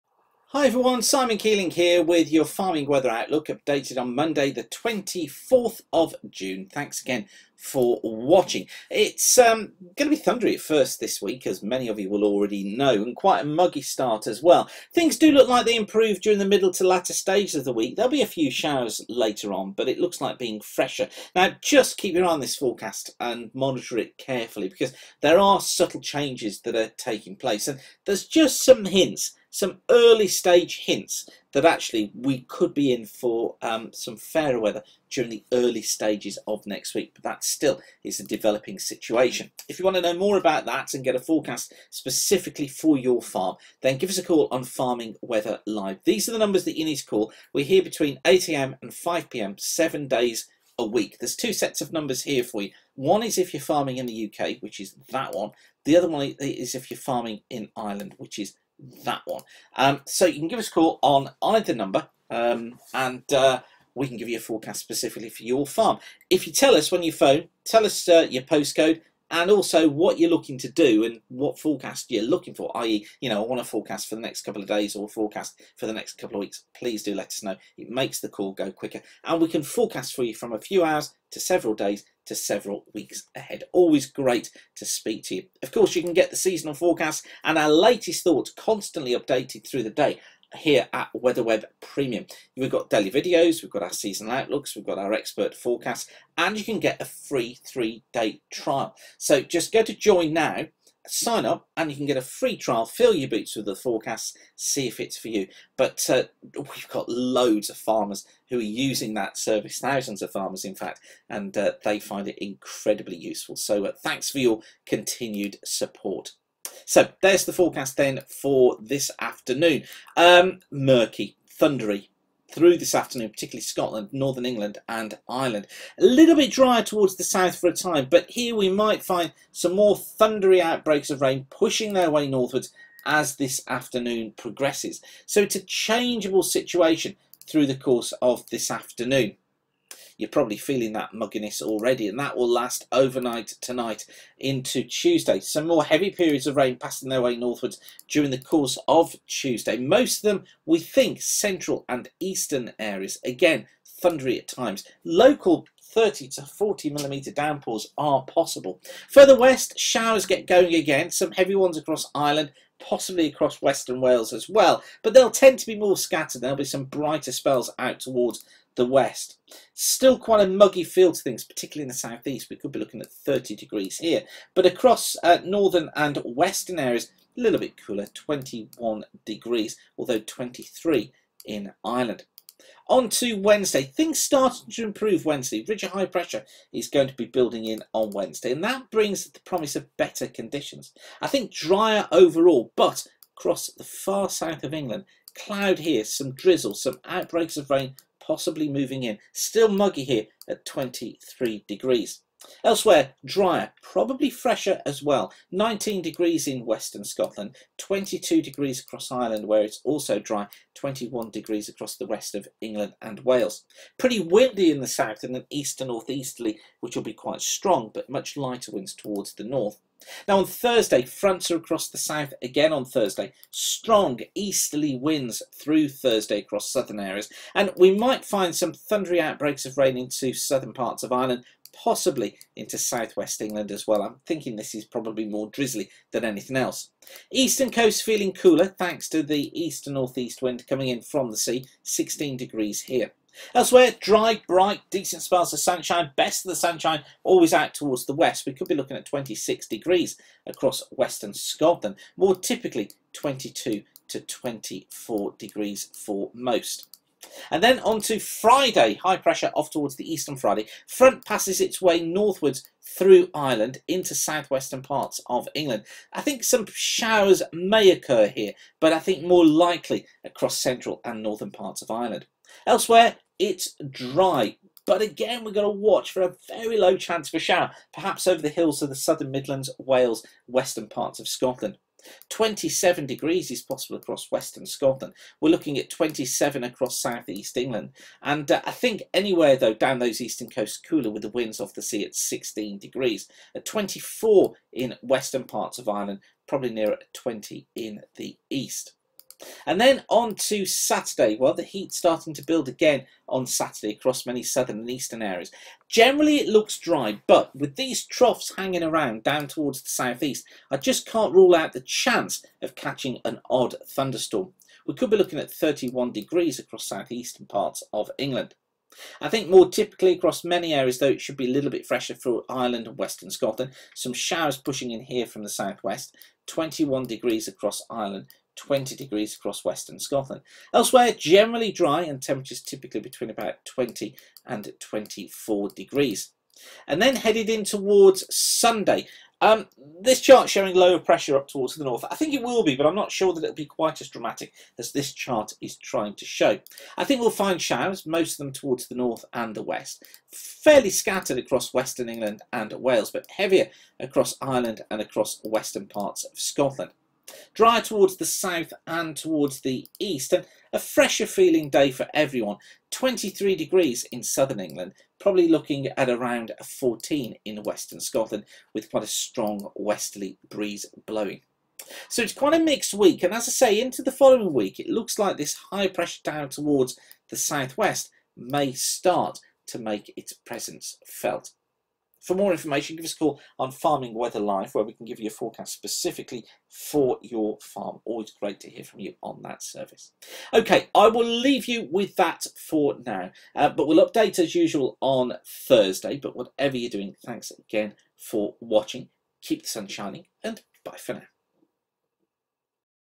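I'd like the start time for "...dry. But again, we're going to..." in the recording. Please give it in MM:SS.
04:33.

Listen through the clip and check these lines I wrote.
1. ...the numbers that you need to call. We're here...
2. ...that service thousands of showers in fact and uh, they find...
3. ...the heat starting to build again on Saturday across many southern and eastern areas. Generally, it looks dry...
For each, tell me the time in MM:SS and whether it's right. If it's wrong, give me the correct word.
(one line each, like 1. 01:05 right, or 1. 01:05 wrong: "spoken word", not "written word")
1. 00:46 right
2. 01:49 wrong: "farmers", not "showers"
3. 05:01 right.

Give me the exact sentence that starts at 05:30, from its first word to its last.
Elsewhere, generally dry and temperatures typically between about 20 and 24 degrees.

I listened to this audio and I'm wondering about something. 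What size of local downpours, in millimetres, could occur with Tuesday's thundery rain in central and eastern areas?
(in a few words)
30 to 40 millimetres.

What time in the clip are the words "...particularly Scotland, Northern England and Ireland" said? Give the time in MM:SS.
02:03.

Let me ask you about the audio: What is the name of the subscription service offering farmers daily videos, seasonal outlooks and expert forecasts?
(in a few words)
WeatherWeb Premium.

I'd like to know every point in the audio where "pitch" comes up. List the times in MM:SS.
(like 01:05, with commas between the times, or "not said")
not said.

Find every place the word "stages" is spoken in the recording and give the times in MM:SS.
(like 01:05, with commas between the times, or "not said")
00:17, 00:30, 00:35.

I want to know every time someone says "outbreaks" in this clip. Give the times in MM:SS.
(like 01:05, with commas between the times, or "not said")
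02:10, 03:17, 03:49.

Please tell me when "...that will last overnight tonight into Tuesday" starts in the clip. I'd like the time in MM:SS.
02:22.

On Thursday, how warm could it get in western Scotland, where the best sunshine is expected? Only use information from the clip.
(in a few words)
26 degrees.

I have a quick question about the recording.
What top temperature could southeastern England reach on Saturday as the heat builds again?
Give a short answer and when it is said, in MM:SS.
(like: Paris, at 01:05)
31 degrees, at 05:15.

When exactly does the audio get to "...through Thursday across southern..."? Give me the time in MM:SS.
03:45.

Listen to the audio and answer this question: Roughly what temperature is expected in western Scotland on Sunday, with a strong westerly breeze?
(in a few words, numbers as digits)
14.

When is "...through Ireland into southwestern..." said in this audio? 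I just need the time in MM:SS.
04:22.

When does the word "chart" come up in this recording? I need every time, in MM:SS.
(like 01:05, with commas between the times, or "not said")
05:40, 05:45.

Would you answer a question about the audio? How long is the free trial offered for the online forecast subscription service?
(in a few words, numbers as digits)
3 days.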